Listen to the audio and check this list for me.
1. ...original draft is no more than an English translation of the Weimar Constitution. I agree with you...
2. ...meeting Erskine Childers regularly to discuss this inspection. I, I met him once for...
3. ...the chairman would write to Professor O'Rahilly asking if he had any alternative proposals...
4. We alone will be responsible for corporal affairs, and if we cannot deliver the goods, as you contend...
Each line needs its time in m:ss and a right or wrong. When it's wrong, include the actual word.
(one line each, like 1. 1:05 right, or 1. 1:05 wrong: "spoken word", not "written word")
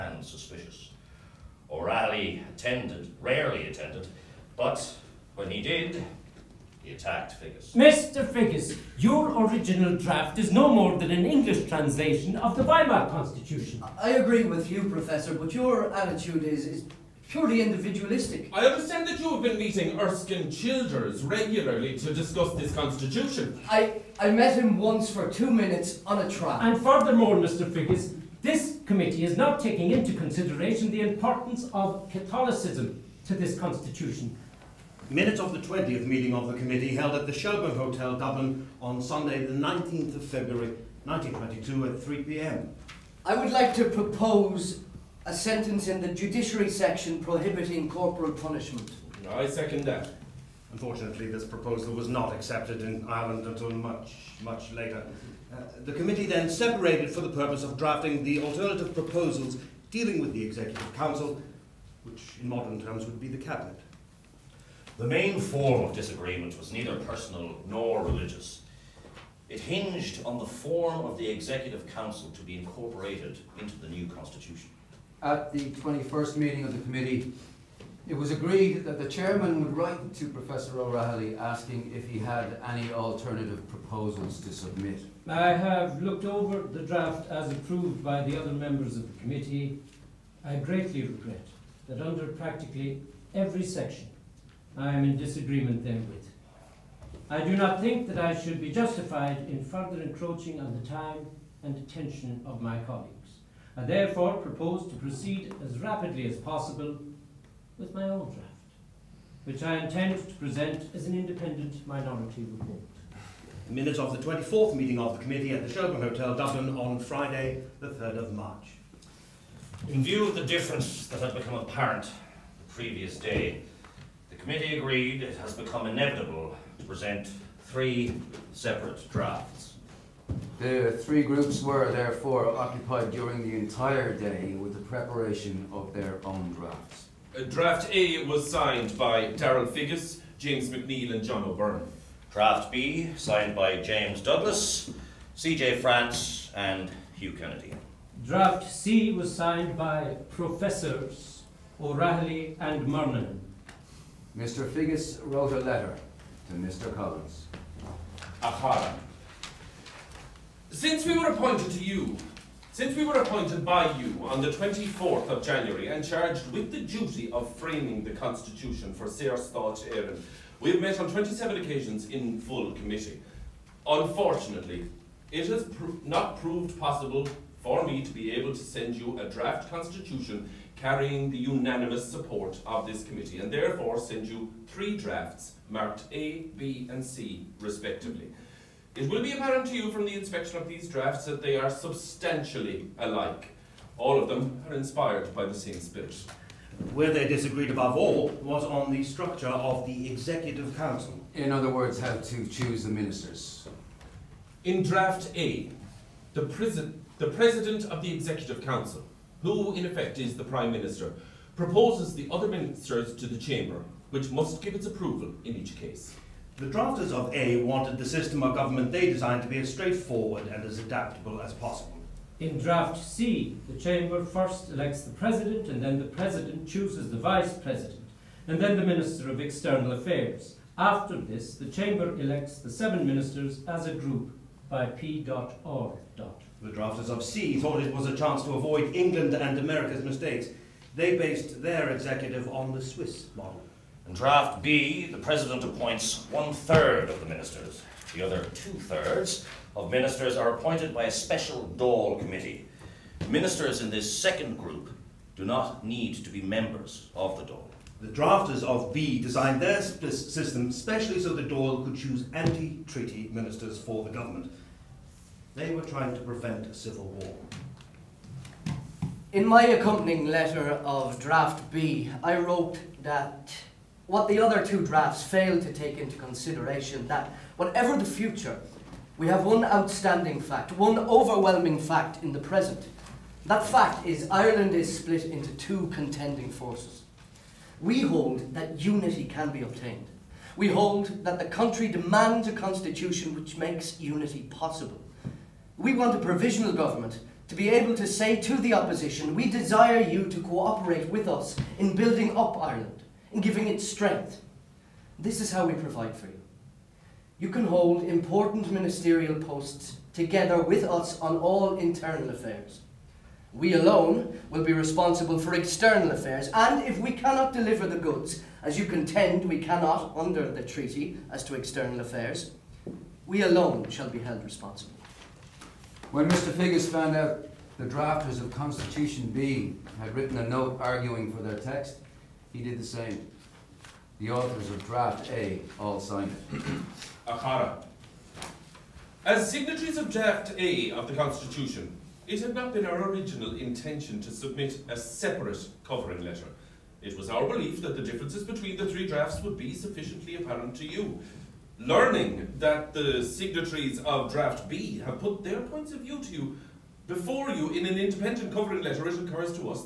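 1. 0:09 right
2. 0:19 wrong: "constitution", not "inspection"
3. 1:18 right
4. 5:13 wrong: "external", not "corporal".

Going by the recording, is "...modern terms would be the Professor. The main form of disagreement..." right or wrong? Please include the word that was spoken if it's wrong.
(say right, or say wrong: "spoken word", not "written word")
wrong: "Cabinet", not "Professor".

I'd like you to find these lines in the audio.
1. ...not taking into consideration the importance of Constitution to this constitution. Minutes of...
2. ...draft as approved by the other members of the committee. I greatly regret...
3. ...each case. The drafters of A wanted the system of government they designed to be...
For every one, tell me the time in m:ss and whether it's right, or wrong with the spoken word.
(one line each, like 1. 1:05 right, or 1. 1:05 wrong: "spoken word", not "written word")
1. 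0:29 wrong: "Catholicism", not "Constitution"
2. 1:26 right
3. 3:35 right.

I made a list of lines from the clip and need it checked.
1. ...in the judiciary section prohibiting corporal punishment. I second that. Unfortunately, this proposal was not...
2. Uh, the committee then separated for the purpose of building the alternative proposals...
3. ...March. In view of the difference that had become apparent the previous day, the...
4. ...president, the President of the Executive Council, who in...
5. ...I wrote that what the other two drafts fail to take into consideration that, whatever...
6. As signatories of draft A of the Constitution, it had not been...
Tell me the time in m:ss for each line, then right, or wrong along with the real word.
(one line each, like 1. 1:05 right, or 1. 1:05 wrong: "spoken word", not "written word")
1. 0:45 right
2. 0:55 wrong: "drafting", not "building"
3. 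1:58 right
4. 3:26 right
5. 4:32 right
6. 5:39 right.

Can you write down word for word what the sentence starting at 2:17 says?
Uh, draft A was signed by Darrell Figgis, James McNeill, and John O'Byrne.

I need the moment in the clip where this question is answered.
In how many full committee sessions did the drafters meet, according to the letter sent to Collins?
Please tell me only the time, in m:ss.
2:51.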